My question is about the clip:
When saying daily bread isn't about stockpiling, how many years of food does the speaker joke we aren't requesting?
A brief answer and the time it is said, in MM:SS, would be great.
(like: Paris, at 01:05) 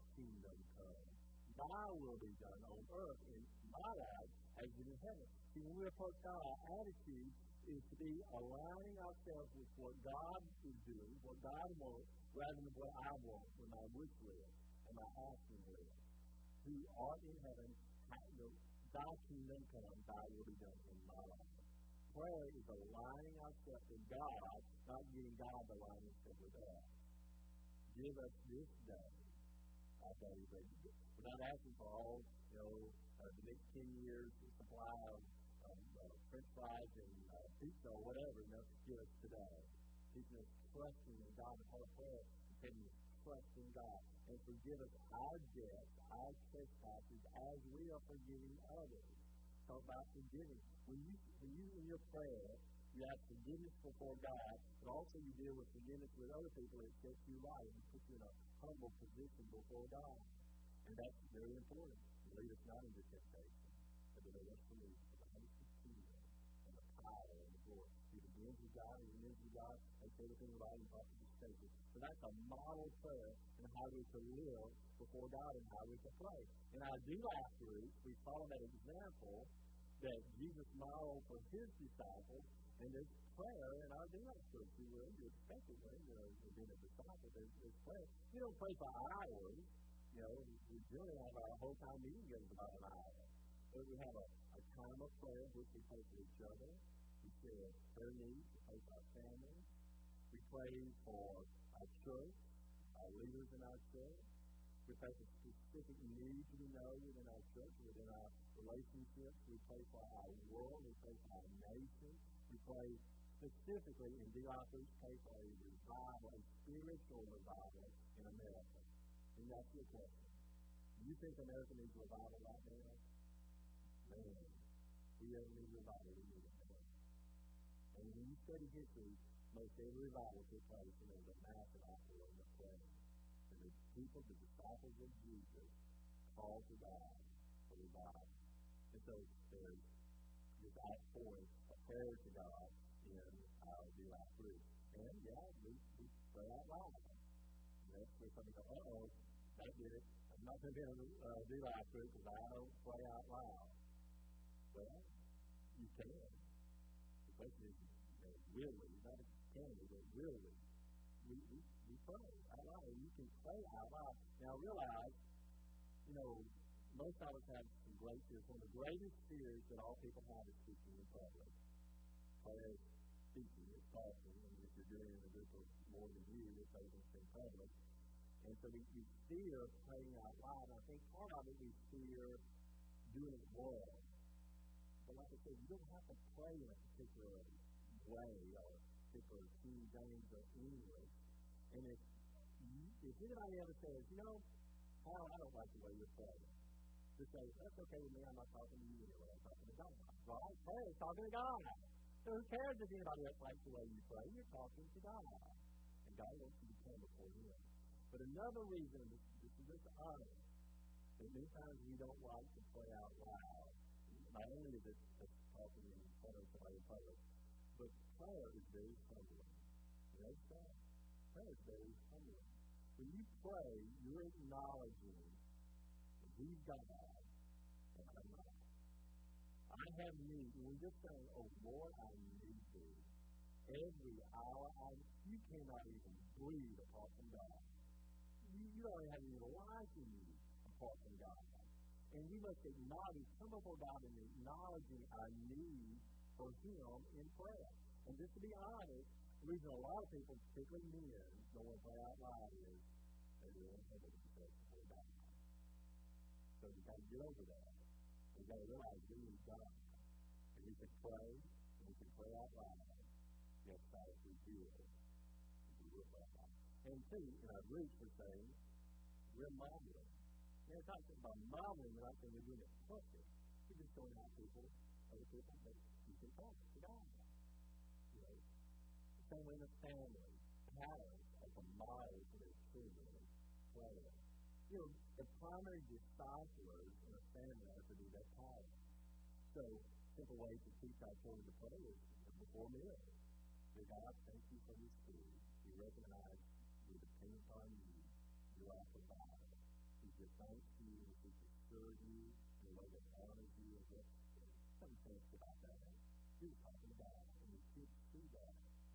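10, at 00:33.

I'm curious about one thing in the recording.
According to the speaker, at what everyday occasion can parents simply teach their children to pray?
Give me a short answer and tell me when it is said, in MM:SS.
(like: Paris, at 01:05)
Before meals, at 04:52.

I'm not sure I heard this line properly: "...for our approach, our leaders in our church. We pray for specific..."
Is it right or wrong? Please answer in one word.
wrong.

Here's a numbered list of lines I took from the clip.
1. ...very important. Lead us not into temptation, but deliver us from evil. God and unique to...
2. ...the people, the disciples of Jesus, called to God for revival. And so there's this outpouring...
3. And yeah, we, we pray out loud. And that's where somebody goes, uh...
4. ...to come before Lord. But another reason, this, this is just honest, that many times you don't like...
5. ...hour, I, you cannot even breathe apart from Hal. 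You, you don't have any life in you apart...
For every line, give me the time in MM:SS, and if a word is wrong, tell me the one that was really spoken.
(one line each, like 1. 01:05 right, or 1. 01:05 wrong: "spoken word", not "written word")
1. 01:01 right
2. 02:13 right
3. 02:24 right
4. 03:26 wrong: "Him", not "Lord"
5. 03:54 wrong: "God", not "Hal".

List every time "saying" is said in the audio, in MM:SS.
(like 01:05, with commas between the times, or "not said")
03:51, 04:28, 04:32.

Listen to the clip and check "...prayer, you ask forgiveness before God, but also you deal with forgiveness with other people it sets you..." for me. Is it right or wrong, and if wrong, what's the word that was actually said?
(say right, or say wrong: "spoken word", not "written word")
right.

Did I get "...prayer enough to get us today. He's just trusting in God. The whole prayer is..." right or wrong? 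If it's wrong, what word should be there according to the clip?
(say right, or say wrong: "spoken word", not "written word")
wrong: "whatever", not "prayer".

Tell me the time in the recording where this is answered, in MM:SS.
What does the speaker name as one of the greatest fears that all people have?
02:50.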